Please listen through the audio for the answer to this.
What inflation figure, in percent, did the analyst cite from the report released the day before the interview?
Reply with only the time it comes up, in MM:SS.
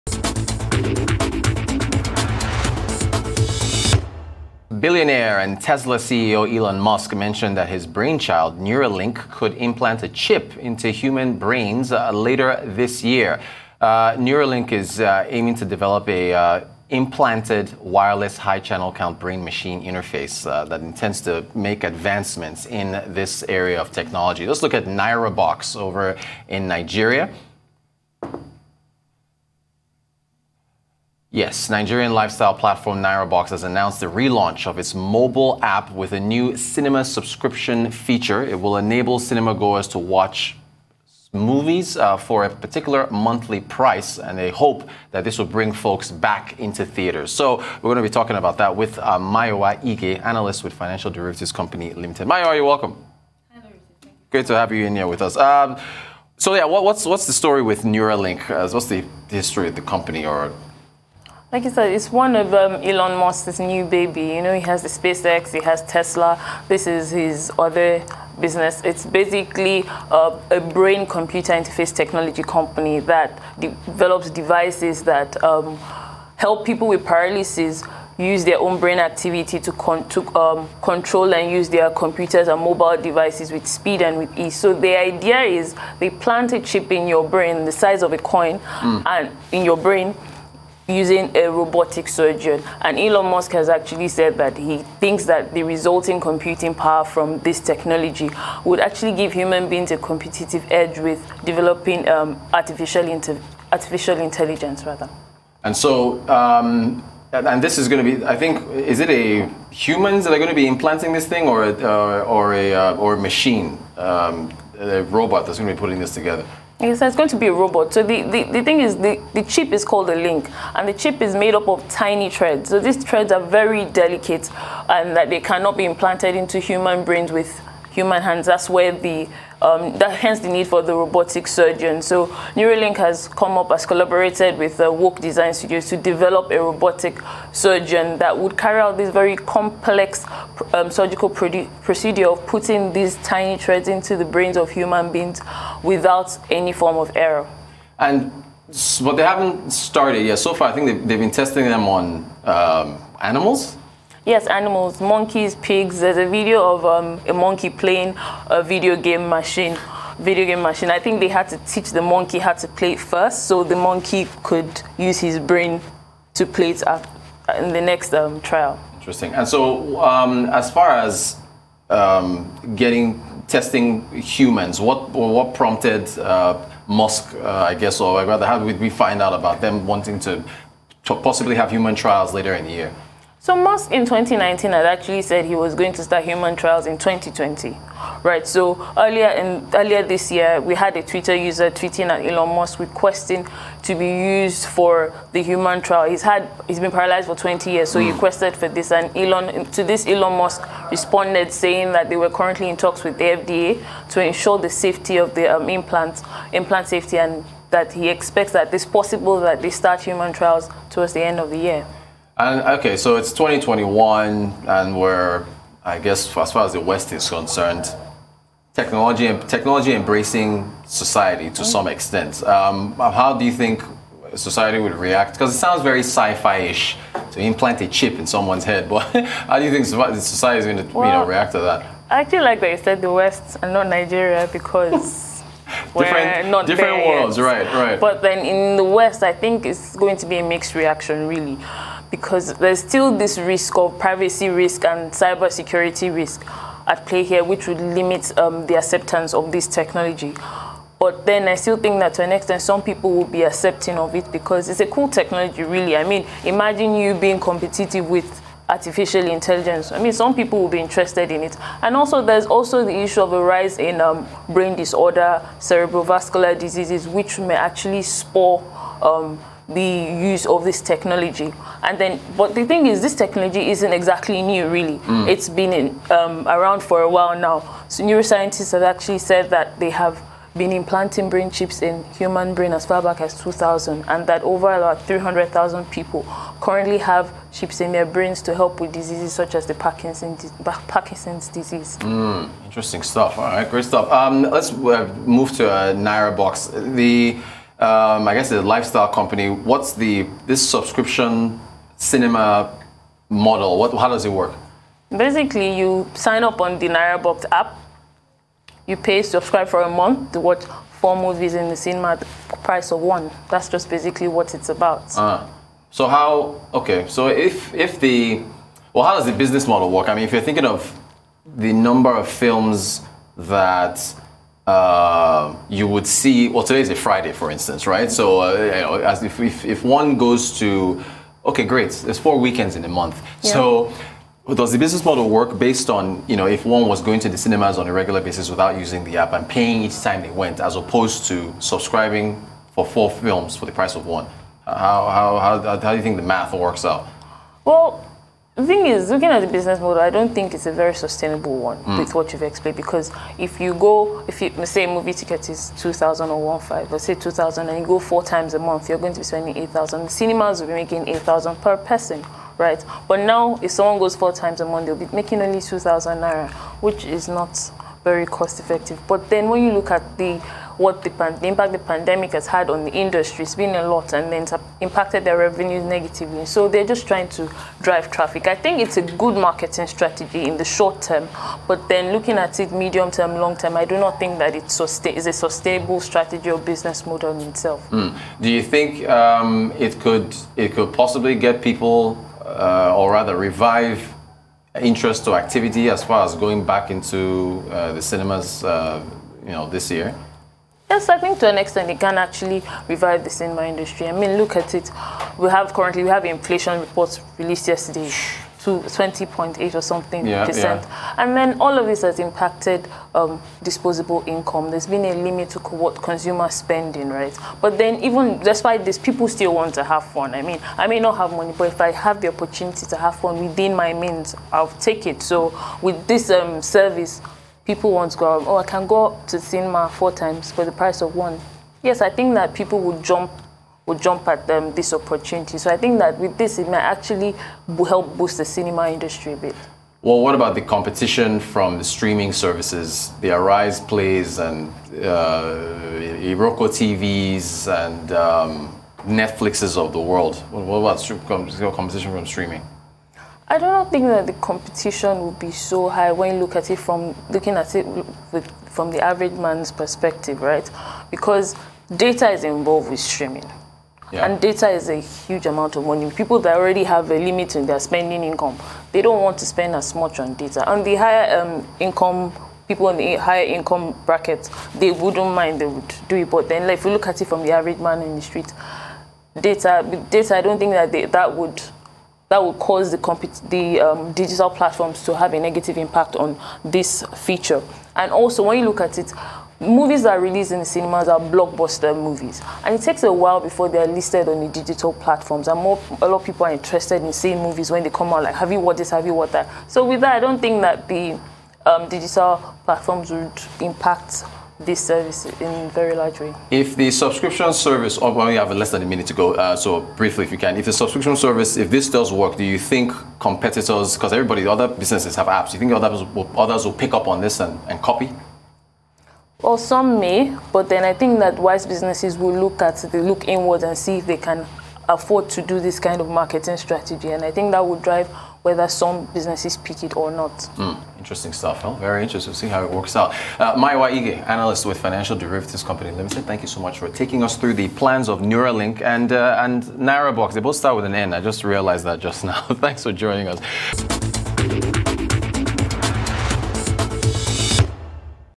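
06:48.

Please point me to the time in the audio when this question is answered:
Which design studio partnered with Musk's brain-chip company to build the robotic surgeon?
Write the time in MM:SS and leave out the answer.
02:14.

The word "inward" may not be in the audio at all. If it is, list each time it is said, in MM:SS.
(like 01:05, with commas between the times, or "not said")
08:43.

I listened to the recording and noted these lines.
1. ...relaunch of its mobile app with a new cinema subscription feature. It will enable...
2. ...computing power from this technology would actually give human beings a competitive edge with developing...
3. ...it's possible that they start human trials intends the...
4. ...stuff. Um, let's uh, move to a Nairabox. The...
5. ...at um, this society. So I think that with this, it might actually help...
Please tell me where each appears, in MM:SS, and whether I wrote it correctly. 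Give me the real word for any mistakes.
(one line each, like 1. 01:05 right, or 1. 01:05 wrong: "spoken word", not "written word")
1. 00:34 right
2. 01:36 right
3. 03:28 wrong: "towards", not "intends"
4. 04:53 right
5. 07:14 wrong: "opportunity", not "society".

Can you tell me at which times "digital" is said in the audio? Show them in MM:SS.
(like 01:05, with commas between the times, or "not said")
08:04, 08:14, 08:21.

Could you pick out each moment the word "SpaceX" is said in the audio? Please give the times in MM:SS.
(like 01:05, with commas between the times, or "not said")
01:04.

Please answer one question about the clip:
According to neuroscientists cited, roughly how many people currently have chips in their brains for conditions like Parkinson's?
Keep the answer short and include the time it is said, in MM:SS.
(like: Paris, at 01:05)
300,000, at 04:45.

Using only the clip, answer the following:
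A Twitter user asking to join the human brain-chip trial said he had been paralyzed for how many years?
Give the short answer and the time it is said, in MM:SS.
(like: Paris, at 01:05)
20, at 03:17.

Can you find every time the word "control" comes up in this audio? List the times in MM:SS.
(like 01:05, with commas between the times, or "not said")
01:20.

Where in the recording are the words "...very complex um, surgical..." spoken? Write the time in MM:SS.
02:19.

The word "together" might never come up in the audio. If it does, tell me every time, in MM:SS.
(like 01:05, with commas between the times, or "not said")
01:56.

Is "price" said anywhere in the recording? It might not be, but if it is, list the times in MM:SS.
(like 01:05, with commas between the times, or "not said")
00:43, 05:12, 05:43, 07:10.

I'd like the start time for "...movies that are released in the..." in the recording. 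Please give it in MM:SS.
08:09.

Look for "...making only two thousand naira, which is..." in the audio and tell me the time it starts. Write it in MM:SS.
06:05.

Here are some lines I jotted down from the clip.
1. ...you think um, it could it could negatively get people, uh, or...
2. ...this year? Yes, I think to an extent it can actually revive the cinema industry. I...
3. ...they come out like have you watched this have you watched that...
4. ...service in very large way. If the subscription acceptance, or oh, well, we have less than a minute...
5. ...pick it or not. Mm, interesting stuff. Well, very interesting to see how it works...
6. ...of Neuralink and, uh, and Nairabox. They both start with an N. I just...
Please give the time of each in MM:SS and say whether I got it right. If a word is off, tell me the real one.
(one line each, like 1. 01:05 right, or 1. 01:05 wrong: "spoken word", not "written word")
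1. 06:28 wrong: "possibly", not "negatively"
2. 06:39 right
3. 08:17 right
4. 08:24 wrong: "service", not "acceptance"
5. 08:49 right
6. 08:58 right.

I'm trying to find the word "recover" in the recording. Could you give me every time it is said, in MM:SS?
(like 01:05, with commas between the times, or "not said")
not said.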